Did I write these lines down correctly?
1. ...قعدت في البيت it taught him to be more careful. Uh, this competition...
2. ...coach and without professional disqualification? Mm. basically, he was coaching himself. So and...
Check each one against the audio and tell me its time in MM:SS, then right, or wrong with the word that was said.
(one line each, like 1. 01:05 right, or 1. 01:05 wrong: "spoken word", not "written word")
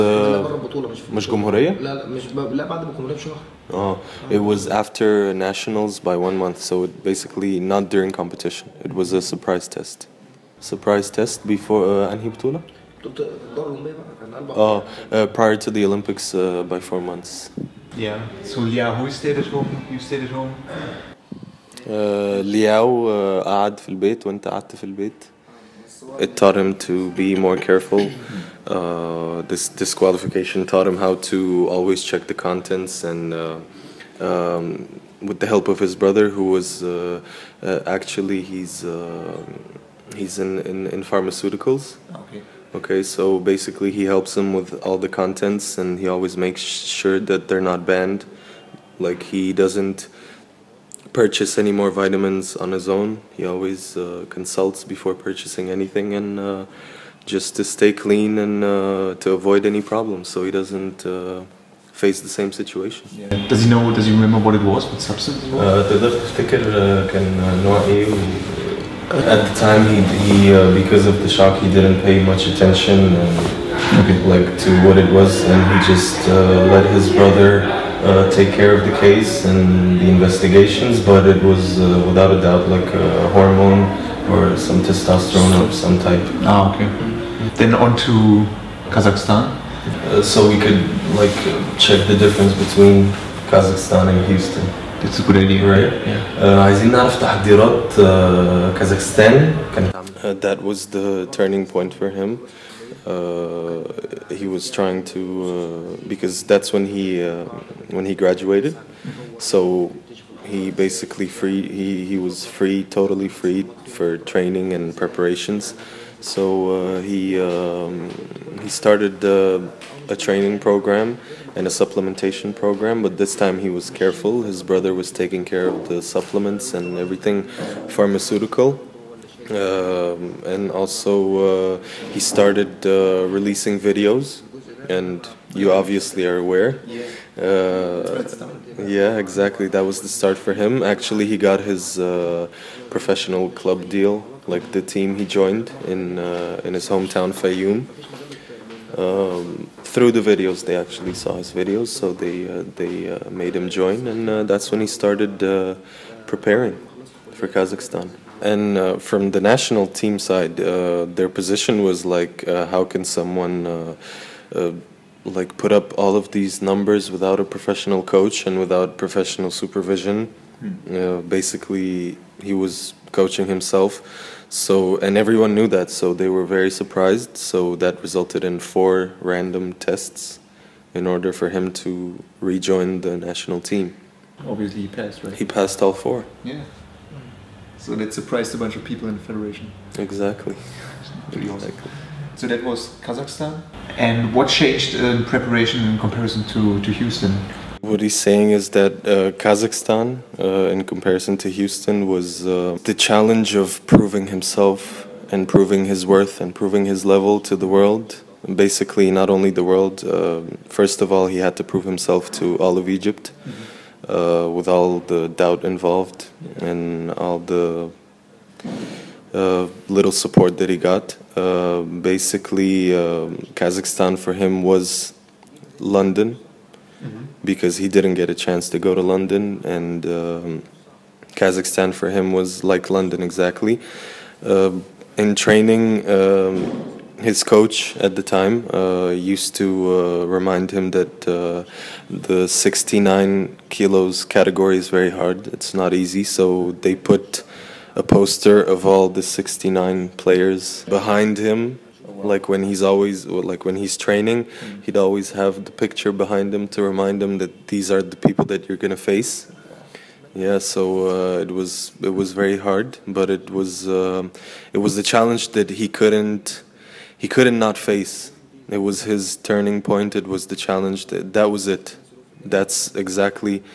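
1. 00:24 wrong: "disqualification", not "competition"
2. 02:48 wrong: "supervision", not "disqualification".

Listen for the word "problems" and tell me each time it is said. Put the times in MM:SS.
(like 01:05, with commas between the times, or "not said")
00:59.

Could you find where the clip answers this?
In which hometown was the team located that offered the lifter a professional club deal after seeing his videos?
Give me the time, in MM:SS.
02:27.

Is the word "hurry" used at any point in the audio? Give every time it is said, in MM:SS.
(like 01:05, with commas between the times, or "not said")
not said.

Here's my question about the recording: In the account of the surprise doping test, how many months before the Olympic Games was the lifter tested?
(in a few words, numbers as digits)
4.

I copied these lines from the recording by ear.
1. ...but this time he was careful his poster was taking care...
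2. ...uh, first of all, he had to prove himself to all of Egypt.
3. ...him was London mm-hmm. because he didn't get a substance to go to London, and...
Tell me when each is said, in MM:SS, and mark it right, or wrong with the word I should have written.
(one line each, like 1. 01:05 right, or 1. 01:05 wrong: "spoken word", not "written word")
1. 02:03 wrong: "brother", not "poster"
2. 03:30 right
3. 03:44 wrong: "chance", not "substance".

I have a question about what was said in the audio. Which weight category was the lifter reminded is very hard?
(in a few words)
69 kilos.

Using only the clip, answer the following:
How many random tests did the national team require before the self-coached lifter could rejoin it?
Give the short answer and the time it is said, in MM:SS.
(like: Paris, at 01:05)
4, at 02:58.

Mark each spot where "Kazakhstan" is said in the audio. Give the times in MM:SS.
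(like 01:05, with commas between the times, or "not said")
01:28, 01:33, 02:37, 03:13, 03:19, 03:43, 03:51.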